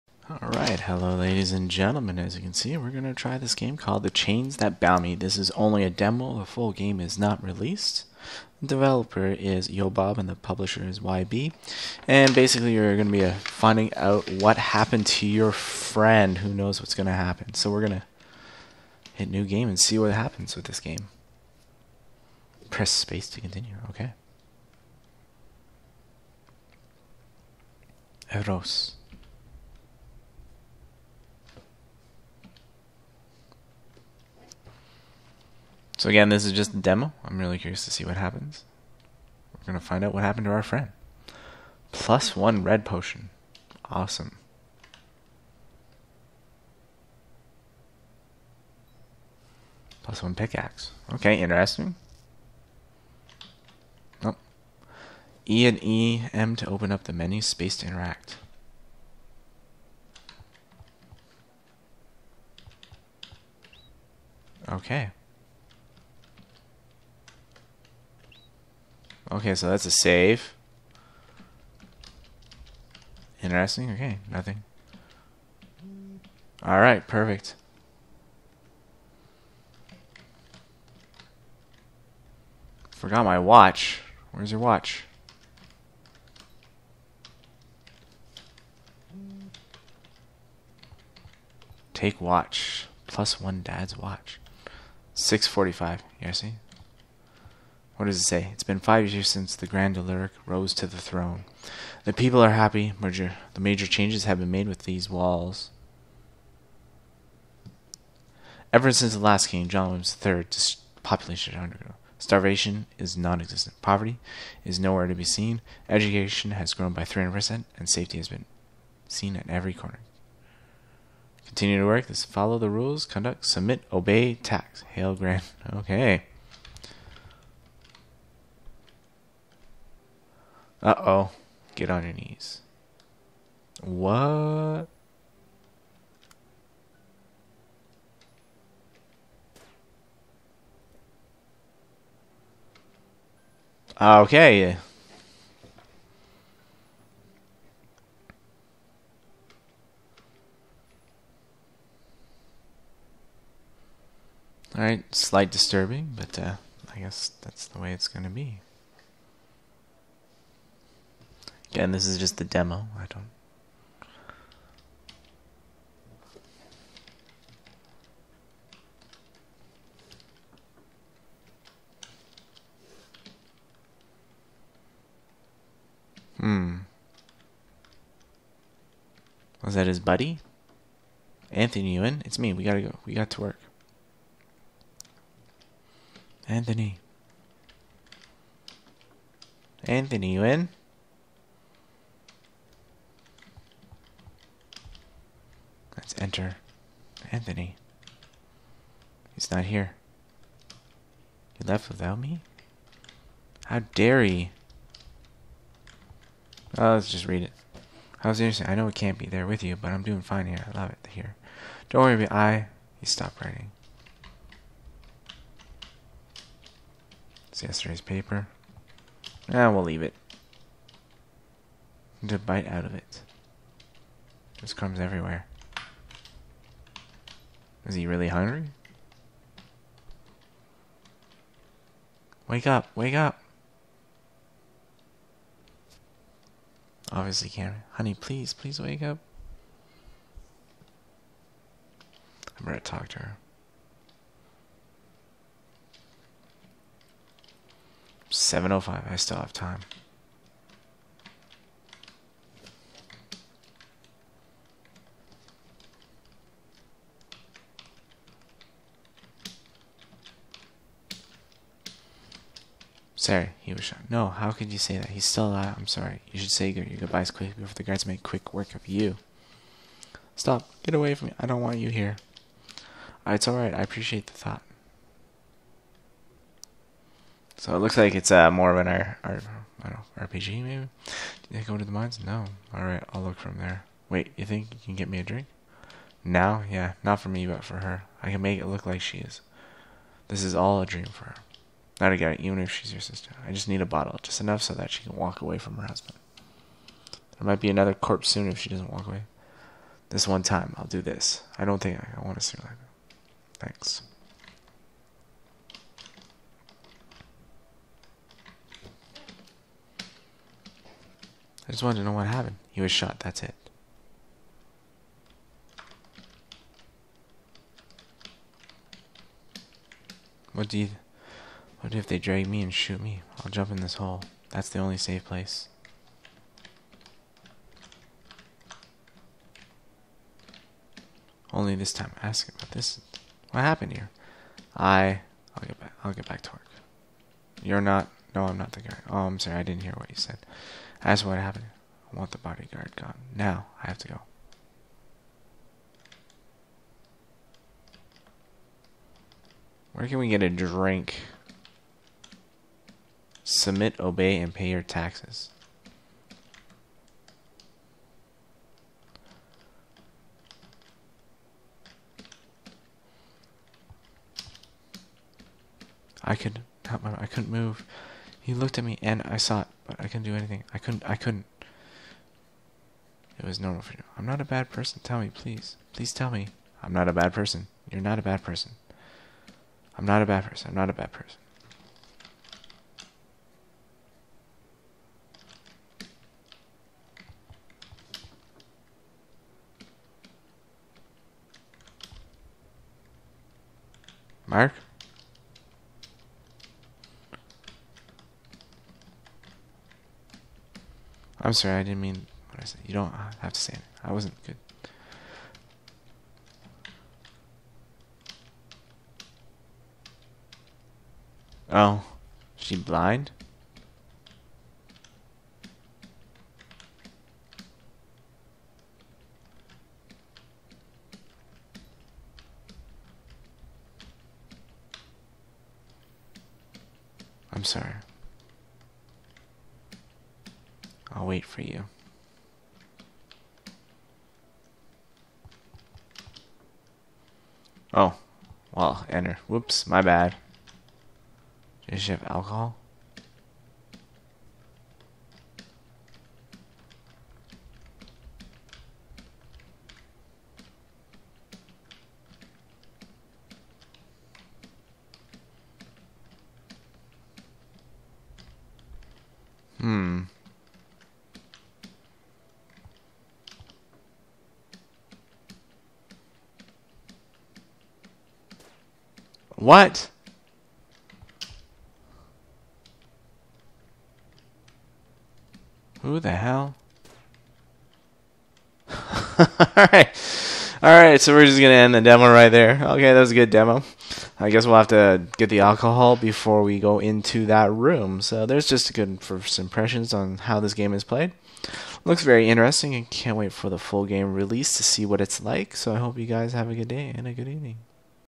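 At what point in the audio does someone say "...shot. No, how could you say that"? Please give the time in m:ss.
4:23.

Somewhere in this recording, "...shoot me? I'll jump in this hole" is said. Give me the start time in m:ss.
5:22.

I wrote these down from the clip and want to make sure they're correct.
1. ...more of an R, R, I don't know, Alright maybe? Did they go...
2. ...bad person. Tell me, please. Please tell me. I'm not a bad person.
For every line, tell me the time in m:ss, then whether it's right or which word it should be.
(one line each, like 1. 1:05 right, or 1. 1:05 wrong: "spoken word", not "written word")
1. 4:38 wrong: "RPG", not "Alright"
2. 6:14 right.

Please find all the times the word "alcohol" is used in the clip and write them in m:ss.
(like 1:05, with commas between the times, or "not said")
7:22, 8:05.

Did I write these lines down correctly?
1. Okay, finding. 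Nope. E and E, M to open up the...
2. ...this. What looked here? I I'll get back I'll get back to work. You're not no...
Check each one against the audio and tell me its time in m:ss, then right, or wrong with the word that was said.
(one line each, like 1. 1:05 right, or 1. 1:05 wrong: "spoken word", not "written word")
1. 0:51 wrong: "interesting", not "finding"
2. 5:32 wrong: "happened", not "looked".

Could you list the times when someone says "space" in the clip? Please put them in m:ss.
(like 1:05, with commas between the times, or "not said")
0:22, 0:57.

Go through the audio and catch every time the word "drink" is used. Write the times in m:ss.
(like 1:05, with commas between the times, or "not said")
4:45, 5:50.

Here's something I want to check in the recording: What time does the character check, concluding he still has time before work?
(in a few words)
7:05.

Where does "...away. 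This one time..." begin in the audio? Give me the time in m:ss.
4:59.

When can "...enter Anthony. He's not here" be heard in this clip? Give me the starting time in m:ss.
3:16.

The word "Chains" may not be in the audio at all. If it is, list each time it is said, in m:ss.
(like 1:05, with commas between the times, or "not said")
0:04.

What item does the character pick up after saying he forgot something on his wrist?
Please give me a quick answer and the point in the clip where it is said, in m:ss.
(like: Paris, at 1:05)
Dad's watch, at 1:33.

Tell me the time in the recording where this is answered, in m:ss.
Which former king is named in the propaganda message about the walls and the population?
1:49.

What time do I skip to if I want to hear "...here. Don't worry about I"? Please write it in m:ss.
3:31.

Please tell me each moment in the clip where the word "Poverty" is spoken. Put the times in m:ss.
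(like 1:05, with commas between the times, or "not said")
1:53.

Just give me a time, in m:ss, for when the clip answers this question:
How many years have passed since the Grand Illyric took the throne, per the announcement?
1:38.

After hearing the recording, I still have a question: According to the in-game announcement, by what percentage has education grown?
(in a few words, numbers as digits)
300%.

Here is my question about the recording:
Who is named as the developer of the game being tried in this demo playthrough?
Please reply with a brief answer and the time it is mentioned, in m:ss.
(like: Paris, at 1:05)
YoBob, at 0:09.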